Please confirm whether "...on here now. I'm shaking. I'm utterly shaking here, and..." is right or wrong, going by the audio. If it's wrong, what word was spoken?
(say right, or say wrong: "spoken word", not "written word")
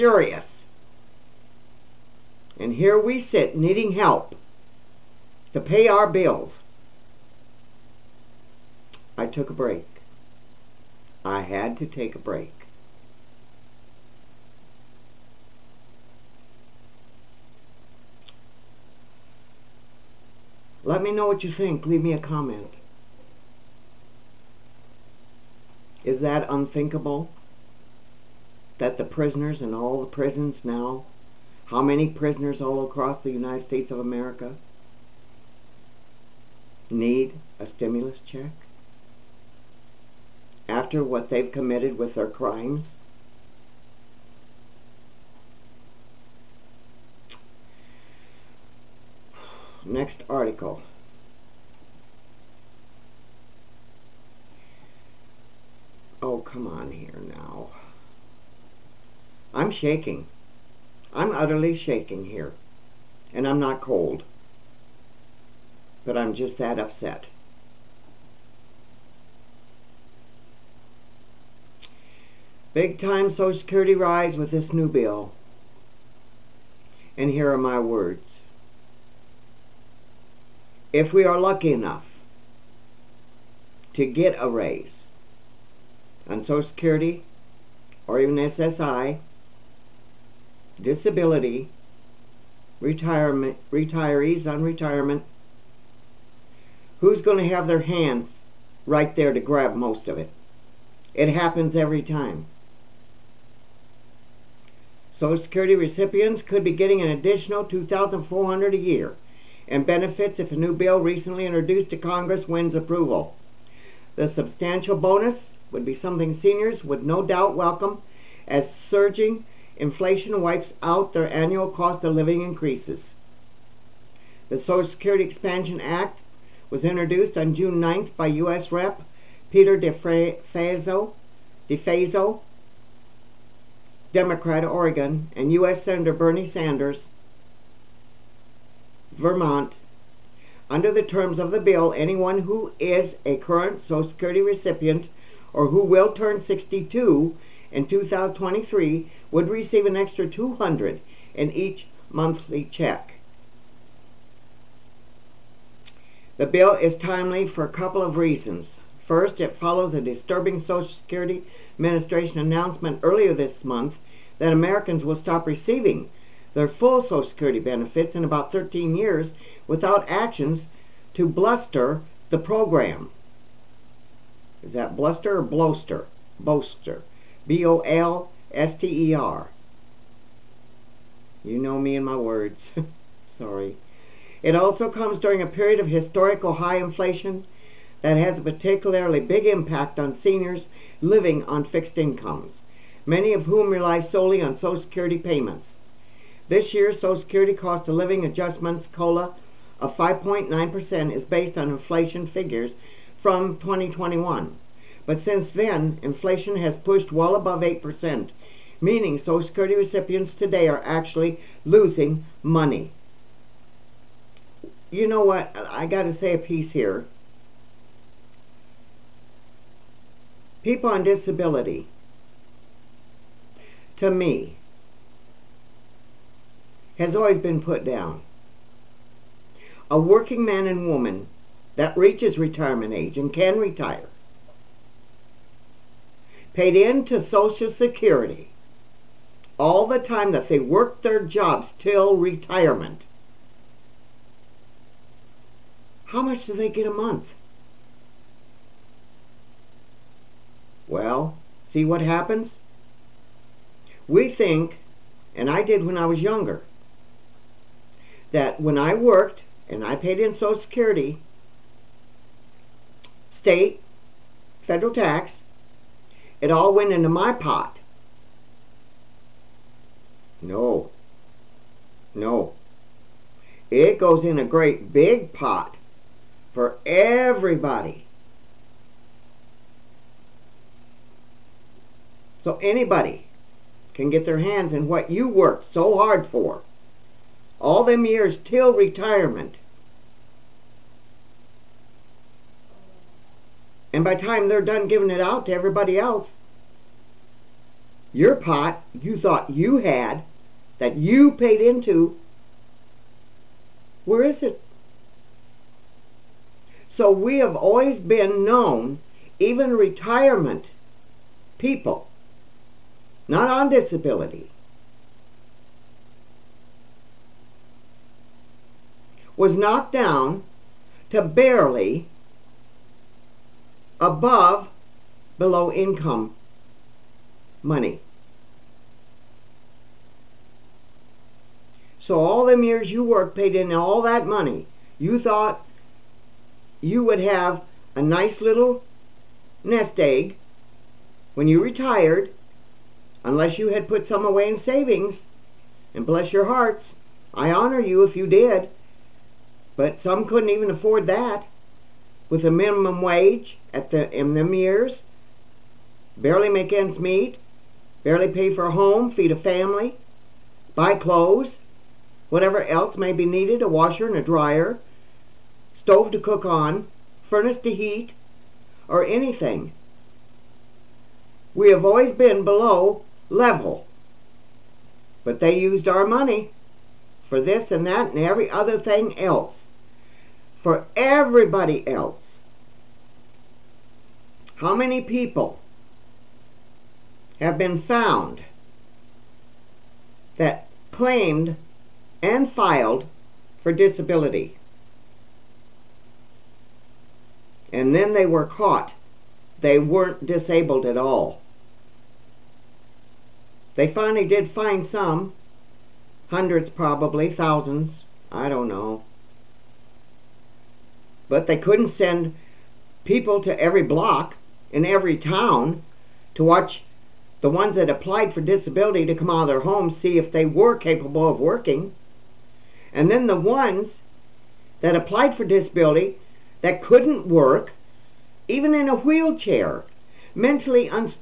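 right.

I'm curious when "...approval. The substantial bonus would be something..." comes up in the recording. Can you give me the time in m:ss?
1:52.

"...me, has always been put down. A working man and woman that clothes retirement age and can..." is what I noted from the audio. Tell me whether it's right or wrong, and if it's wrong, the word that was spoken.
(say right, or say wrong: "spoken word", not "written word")
wrong: "reaches", not "clothes".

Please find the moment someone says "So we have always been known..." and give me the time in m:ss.
5:06.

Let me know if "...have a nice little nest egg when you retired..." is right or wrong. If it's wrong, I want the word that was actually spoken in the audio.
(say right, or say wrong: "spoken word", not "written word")
right.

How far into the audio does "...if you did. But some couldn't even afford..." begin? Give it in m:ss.
5:48.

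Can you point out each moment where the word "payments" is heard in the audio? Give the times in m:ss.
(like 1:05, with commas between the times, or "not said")
3:15.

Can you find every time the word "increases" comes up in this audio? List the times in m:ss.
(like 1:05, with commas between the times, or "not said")
2:02.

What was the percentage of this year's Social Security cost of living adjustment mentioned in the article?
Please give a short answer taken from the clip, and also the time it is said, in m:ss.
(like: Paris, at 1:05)
5.9%, at 3:19.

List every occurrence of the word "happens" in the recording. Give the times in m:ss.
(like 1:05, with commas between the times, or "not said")
1:41, 4:12.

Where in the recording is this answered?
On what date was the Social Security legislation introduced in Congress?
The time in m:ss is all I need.
2:07.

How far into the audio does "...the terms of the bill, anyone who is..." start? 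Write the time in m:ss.
2:20.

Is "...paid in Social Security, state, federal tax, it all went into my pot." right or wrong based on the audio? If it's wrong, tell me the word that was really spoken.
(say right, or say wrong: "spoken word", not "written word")
right.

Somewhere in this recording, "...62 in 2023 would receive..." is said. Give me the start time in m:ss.
2:26.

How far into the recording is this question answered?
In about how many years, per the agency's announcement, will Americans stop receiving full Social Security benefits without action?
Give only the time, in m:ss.
2:48.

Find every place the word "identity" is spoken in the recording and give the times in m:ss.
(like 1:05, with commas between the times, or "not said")
not said.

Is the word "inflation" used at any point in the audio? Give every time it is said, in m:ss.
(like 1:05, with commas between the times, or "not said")
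1:59, 3:06, 3:21, 3:26.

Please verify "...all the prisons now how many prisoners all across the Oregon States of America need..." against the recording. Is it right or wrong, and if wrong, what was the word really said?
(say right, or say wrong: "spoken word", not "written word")
wrong: "United", not "Oregon".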